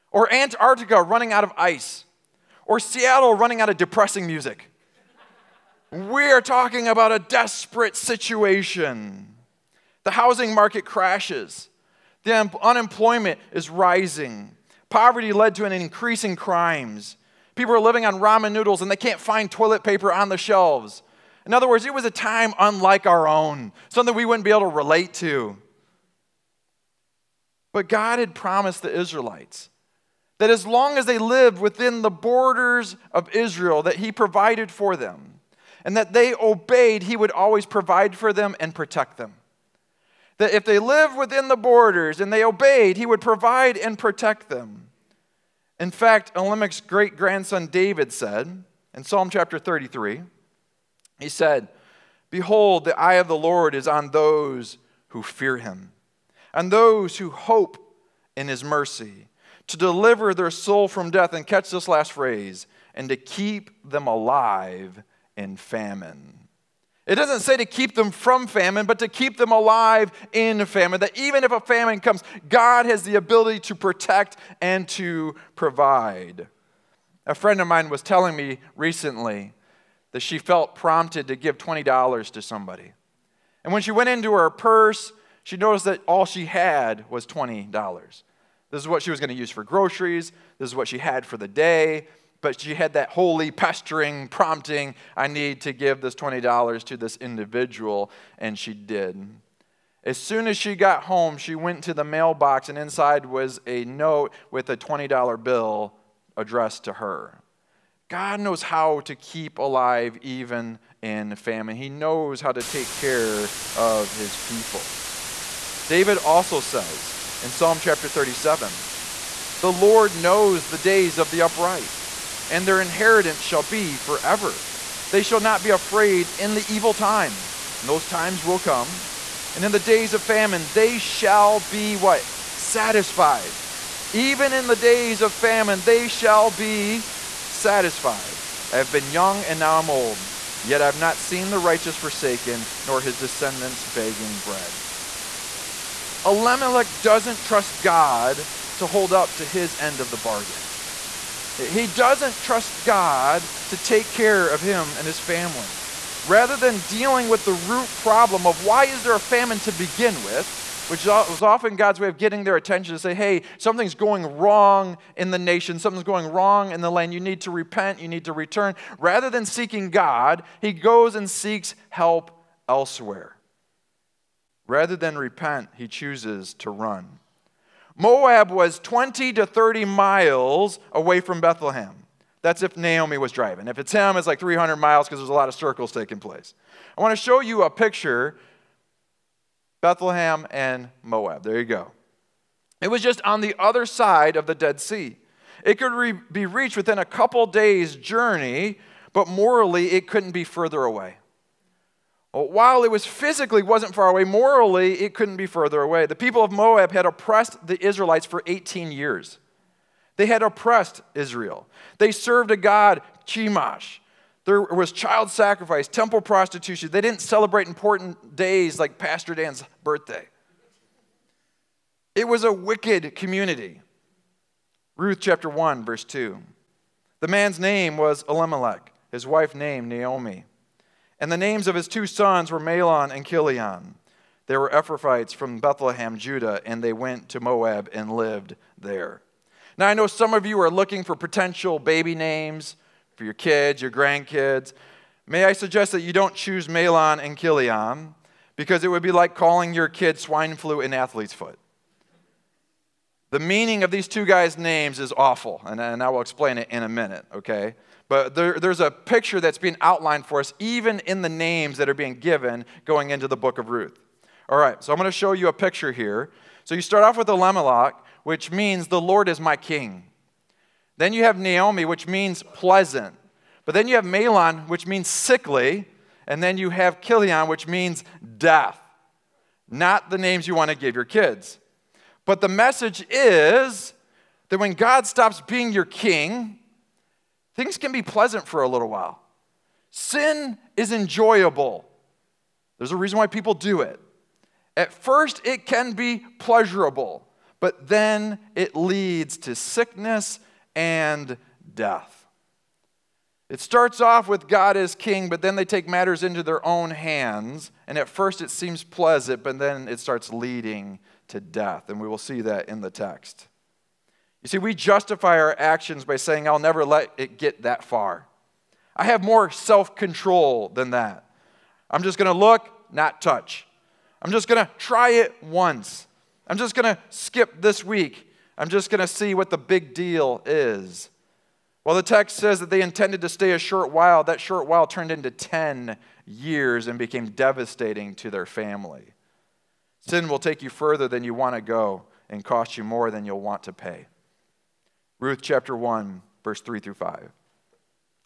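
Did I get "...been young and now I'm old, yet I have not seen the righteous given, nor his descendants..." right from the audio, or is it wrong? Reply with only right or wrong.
wrong.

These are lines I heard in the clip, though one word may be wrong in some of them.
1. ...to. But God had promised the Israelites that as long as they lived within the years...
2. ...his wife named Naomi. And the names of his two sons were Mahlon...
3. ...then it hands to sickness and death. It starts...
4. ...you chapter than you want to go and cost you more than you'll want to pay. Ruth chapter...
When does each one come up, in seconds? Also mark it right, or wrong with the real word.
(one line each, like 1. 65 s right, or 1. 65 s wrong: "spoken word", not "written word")
1. 25 s wrong: "borders", not "years"
2. 229 s right
3. 297 s wrong: "leads", not "hands"
4. 340 s wrong: "further", not "chapter".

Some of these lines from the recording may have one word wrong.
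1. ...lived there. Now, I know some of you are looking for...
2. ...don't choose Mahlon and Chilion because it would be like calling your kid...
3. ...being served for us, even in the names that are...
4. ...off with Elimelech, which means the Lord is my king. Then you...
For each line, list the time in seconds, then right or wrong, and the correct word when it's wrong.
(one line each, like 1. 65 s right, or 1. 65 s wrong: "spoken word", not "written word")
1. 238 s right
2. 246 s right
3. 259 s wrong: "outlined", not "served"
4. 267 s right.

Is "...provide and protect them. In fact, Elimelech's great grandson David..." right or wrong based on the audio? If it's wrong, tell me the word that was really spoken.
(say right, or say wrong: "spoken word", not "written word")
right.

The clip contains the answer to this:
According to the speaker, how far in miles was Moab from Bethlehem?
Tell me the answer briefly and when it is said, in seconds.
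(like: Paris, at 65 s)
20 to 30 miles, at 178 s.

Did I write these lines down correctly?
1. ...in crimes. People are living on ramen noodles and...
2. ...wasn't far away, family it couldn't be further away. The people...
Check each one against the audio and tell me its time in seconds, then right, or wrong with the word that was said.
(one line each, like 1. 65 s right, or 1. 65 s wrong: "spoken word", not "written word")
1. 16 s right
2. 203 s wrong: "morally", not "family".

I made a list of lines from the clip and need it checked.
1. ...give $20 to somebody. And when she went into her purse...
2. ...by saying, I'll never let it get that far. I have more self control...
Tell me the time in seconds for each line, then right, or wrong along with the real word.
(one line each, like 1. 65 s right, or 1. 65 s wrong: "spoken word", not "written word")
1. 81 s right
2. 316 s right.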